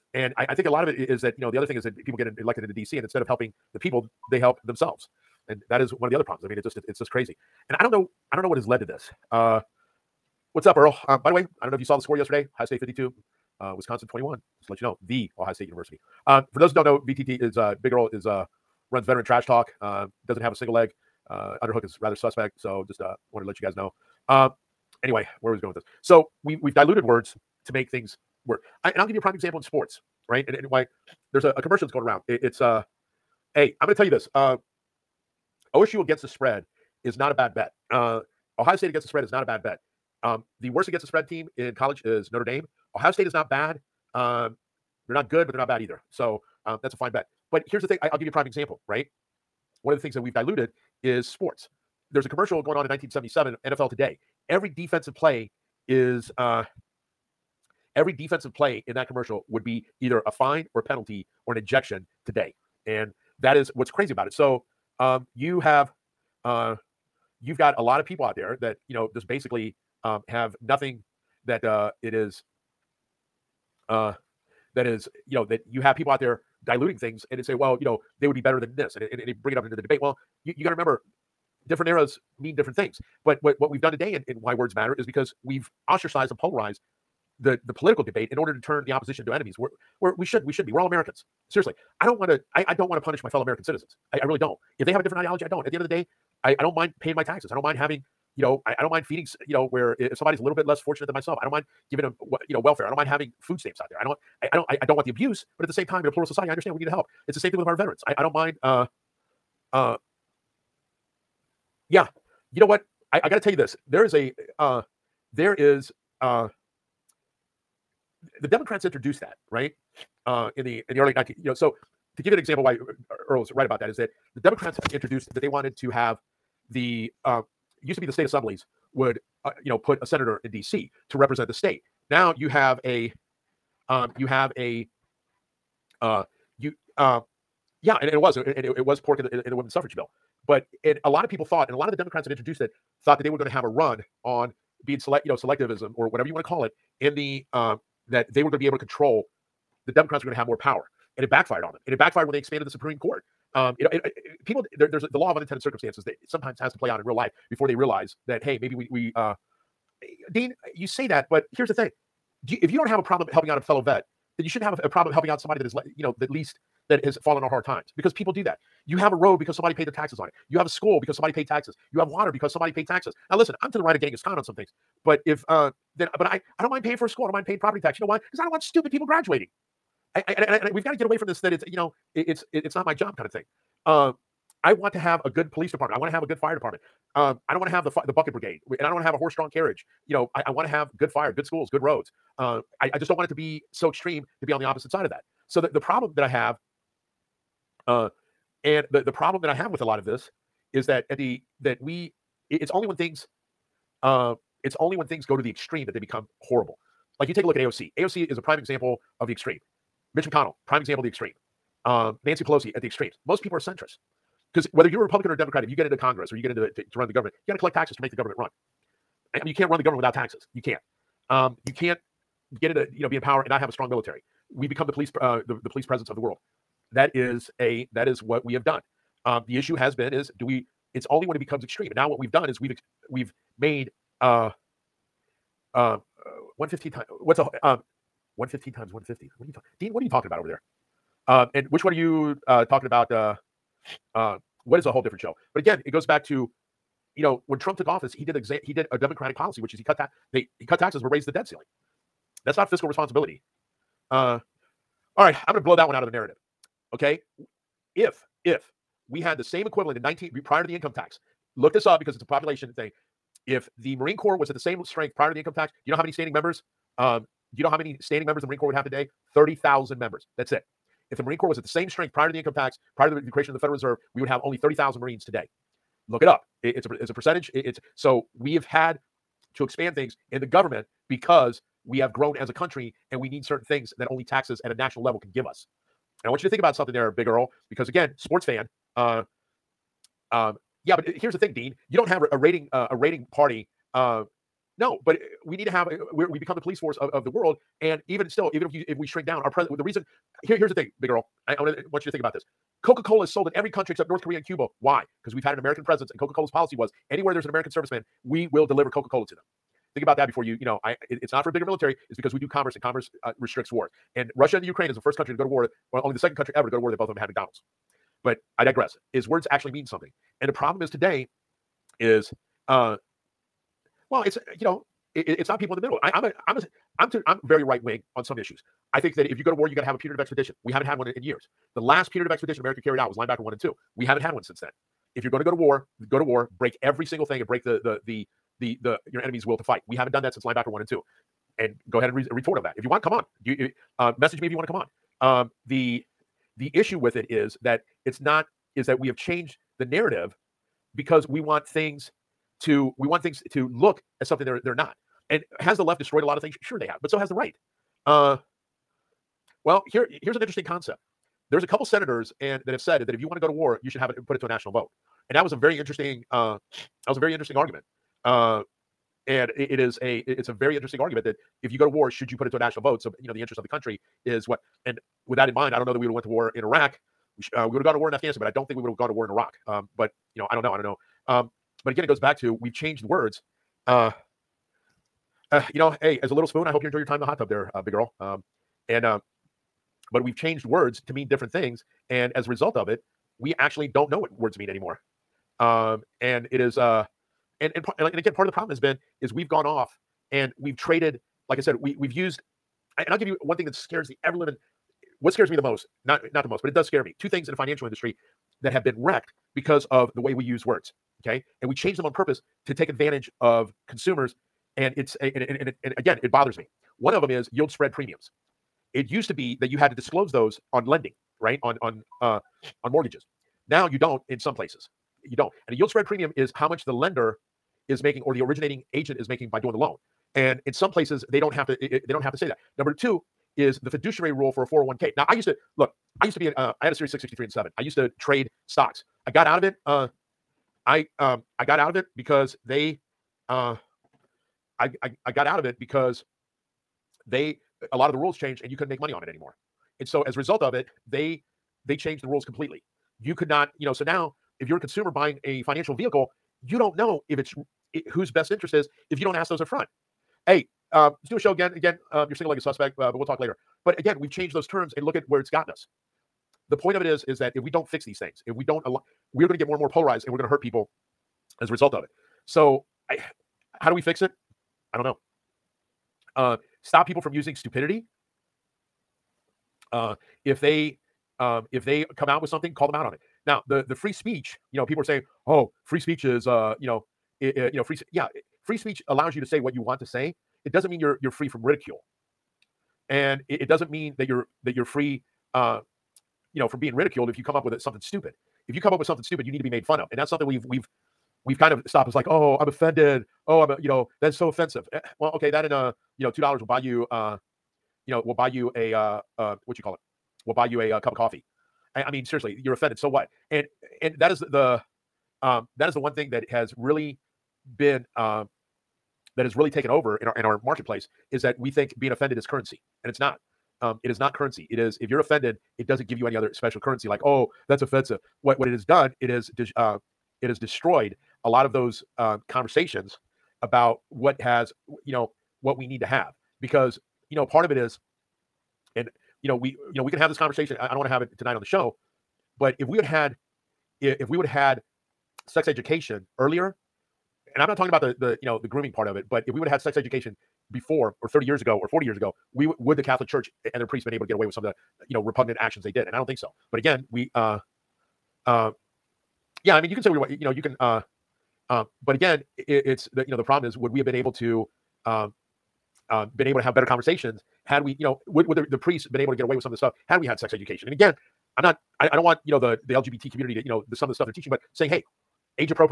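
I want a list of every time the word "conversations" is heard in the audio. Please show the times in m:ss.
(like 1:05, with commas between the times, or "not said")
8:52, 9:00, 9:26.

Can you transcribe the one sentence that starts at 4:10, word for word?
They he cut taxes but raised the debt ceiling.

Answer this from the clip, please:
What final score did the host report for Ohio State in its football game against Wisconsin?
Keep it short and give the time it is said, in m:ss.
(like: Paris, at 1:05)
52, at 0:12.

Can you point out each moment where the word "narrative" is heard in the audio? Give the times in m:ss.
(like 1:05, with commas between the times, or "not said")
4:16, 5:49.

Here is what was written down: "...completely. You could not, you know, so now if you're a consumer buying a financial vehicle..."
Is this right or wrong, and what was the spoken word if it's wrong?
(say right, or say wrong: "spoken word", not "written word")
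right.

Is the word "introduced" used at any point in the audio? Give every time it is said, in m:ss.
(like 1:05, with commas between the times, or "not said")
1:58, 2:04, 2:22.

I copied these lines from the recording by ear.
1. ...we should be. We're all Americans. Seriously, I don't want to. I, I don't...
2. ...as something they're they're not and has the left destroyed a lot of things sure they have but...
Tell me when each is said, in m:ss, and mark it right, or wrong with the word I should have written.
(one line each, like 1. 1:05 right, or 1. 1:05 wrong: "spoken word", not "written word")
1. 1:30 right
2. 5:54 right.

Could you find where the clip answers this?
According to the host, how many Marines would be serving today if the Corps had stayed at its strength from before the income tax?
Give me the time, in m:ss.
4:29.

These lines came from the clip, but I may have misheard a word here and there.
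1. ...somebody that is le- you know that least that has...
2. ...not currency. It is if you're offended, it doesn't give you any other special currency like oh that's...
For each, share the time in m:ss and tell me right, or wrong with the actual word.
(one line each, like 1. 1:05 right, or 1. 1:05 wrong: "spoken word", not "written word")
1. 2:45 right
2. 8:44 right.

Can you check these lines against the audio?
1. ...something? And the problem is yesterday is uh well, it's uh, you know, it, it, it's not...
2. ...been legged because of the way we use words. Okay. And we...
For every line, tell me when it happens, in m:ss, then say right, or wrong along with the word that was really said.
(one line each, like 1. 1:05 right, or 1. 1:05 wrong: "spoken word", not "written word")
1. 5:19 wrong: "today", not "yesterday"
2. 6:48 wrong: "wrecked", not "legged".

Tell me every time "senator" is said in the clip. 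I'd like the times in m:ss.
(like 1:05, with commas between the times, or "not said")
2:10, 6:01.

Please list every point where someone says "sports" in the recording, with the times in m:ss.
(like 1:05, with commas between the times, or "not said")
0:29, 0:51, 4:48.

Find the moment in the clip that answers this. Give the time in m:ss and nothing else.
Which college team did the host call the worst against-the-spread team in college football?
0:42.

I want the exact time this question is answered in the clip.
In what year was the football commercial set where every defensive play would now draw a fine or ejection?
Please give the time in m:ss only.
0:52.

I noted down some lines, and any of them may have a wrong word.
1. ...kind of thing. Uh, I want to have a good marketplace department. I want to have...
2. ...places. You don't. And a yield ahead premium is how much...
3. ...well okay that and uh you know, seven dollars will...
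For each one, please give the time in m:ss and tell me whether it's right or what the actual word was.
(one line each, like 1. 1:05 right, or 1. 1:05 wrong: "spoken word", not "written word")
1. 3:03 wrong: "police", not "marketplace"
2. 7:04 wrong: "spread", not "ahead"
3. 8:25 wrong: "two", not "seven".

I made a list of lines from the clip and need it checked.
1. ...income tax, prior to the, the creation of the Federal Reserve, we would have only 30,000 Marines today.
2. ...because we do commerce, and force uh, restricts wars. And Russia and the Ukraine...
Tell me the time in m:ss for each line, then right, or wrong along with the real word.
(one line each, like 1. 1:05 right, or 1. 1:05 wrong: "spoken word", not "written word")
1. 4:32 right
2. 5:12 wrong: "commerce", not "force".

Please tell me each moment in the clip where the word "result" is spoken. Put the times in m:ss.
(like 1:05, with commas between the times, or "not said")
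6:32, 7:30, 7:51.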